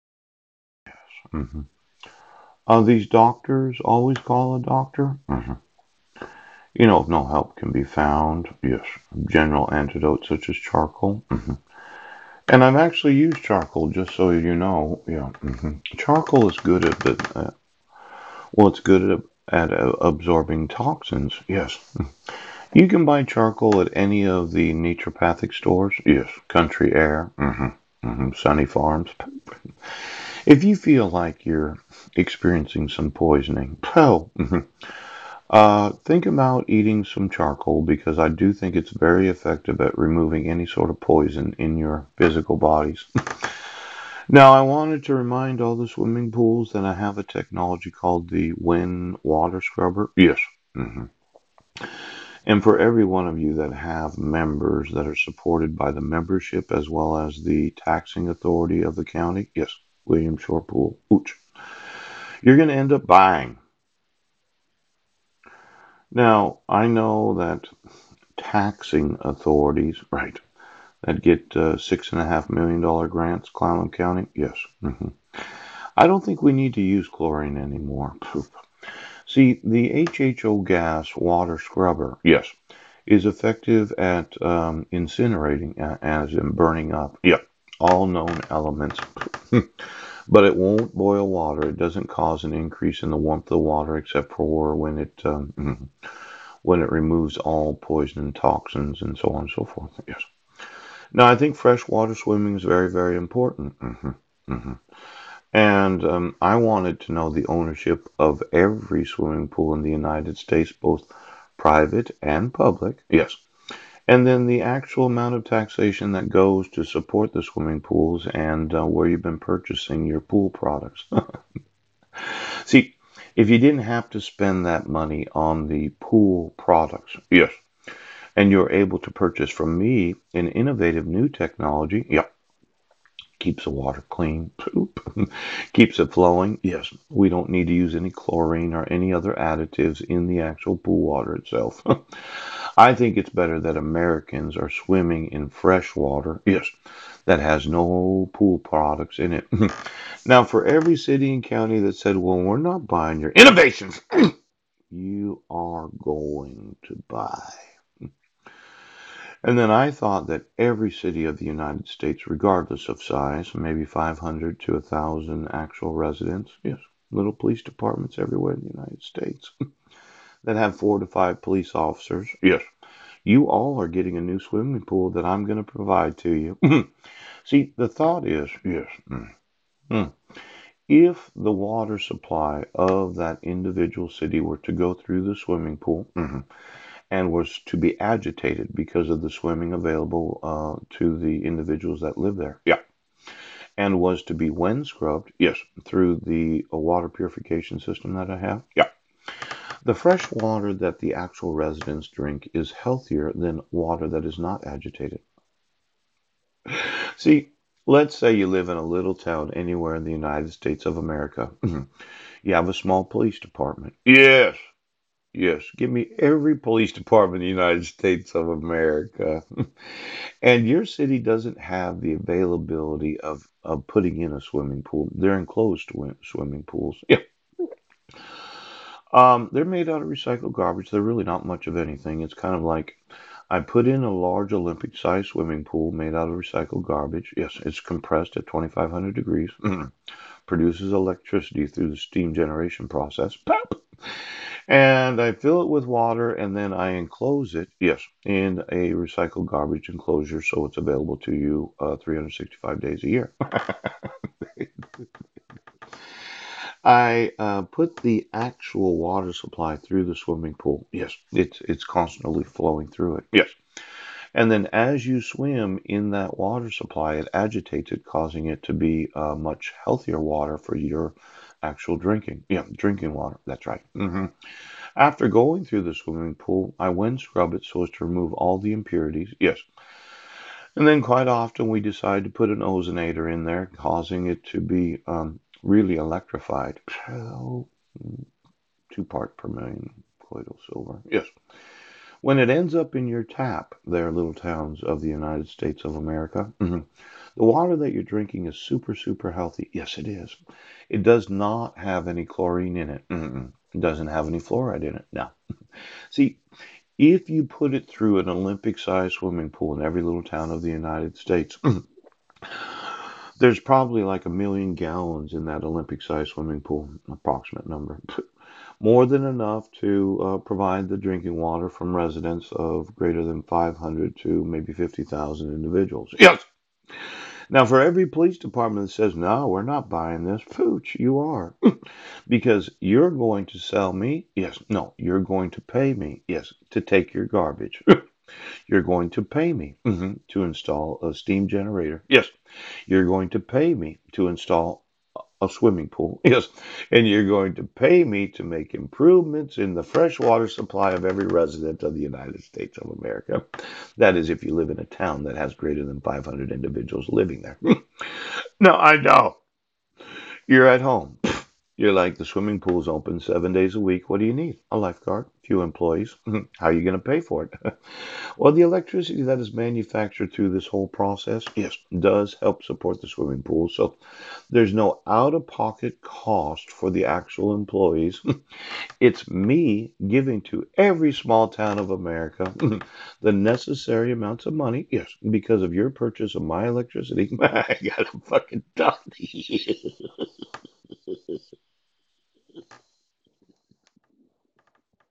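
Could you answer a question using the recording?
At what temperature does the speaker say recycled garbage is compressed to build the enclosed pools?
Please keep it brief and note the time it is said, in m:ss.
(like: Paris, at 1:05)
2500 degrees, at 3:58.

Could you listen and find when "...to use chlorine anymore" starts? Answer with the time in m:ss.
1:16.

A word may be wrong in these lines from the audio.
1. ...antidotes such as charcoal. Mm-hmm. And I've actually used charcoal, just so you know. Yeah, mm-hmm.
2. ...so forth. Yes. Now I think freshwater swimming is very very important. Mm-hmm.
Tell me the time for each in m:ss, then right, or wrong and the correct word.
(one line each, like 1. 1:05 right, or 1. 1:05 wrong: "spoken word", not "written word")
1. 0:09 right
2. 1:39 right.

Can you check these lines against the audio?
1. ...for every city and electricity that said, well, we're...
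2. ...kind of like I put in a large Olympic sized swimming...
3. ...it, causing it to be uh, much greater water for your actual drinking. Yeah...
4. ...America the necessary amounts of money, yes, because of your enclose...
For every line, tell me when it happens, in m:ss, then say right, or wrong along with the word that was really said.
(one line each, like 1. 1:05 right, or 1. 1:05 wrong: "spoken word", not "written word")
1. 2:30 wrong: "county", not "electricity"
2. 3:52 right
3. 4:27 wrong: "healthier", not "greater"
4. 6:21 wrong: "purchase", not "enclose".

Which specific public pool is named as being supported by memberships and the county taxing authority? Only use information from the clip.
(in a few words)
William Shore Pool.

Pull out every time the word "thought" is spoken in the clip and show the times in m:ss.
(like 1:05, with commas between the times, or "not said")
2:39, 2:57.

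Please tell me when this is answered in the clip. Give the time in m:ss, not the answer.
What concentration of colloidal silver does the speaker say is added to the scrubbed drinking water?
4:47.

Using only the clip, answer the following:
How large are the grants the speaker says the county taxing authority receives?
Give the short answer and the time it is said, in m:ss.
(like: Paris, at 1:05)
$6.5 million, at 1:11.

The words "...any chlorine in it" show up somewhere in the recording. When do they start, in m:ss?
5:02.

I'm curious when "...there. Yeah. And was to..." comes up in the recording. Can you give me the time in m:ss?
3:12.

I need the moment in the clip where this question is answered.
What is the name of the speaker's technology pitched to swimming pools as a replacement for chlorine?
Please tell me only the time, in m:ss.
0:48.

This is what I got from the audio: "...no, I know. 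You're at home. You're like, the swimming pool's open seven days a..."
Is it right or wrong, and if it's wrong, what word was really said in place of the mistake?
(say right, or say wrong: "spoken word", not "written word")
right.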